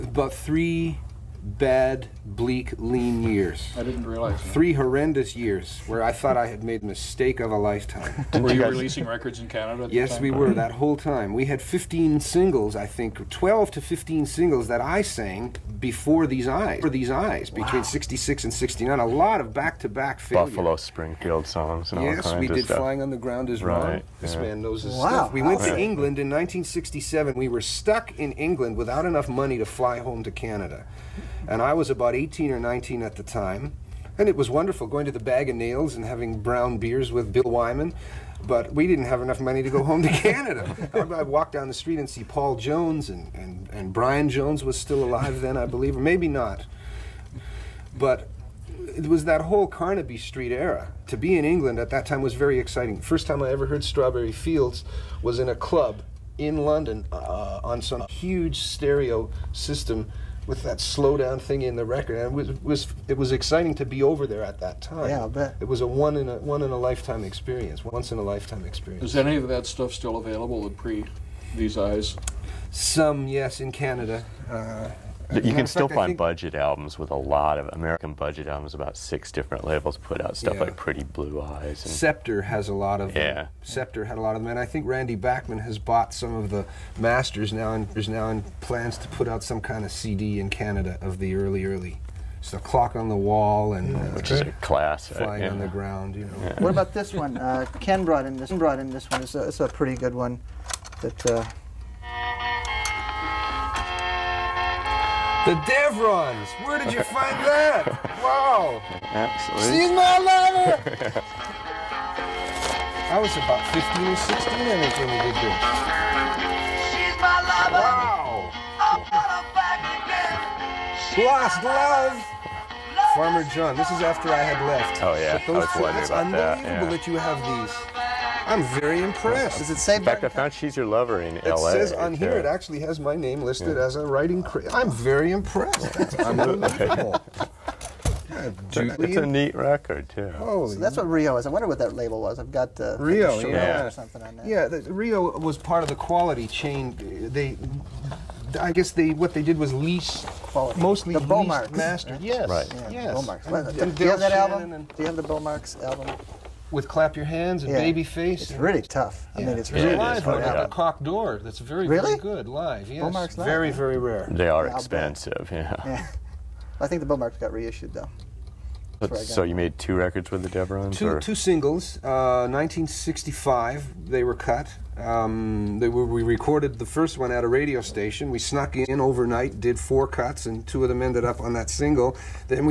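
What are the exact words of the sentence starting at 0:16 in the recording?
For these eyes, between 66 and 69, a lot of back-to-back failure.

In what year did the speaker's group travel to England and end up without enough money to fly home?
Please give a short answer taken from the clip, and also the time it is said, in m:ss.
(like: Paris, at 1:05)
1967, at 0:26.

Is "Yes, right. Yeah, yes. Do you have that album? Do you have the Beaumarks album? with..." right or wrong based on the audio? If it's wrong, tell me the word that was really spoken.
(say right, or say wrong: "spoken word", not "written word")
right.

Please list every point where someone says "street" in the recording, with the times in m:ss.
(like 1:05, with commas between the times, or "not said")
0:41, 0:50.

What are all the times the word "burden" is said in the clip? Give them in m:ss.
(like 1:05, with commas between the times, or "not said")
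not said.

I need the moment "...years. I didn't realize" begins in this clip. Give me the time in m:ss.
0:03.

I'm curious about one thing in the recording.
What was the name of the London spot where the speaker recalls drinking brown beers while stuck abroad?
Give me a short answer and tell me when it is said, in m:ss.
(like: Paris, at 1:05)
Bag of Nails, at 0:35.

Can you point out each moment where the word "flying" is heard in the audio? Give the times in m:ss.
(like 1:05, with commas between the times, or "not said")
0:22, 1:35.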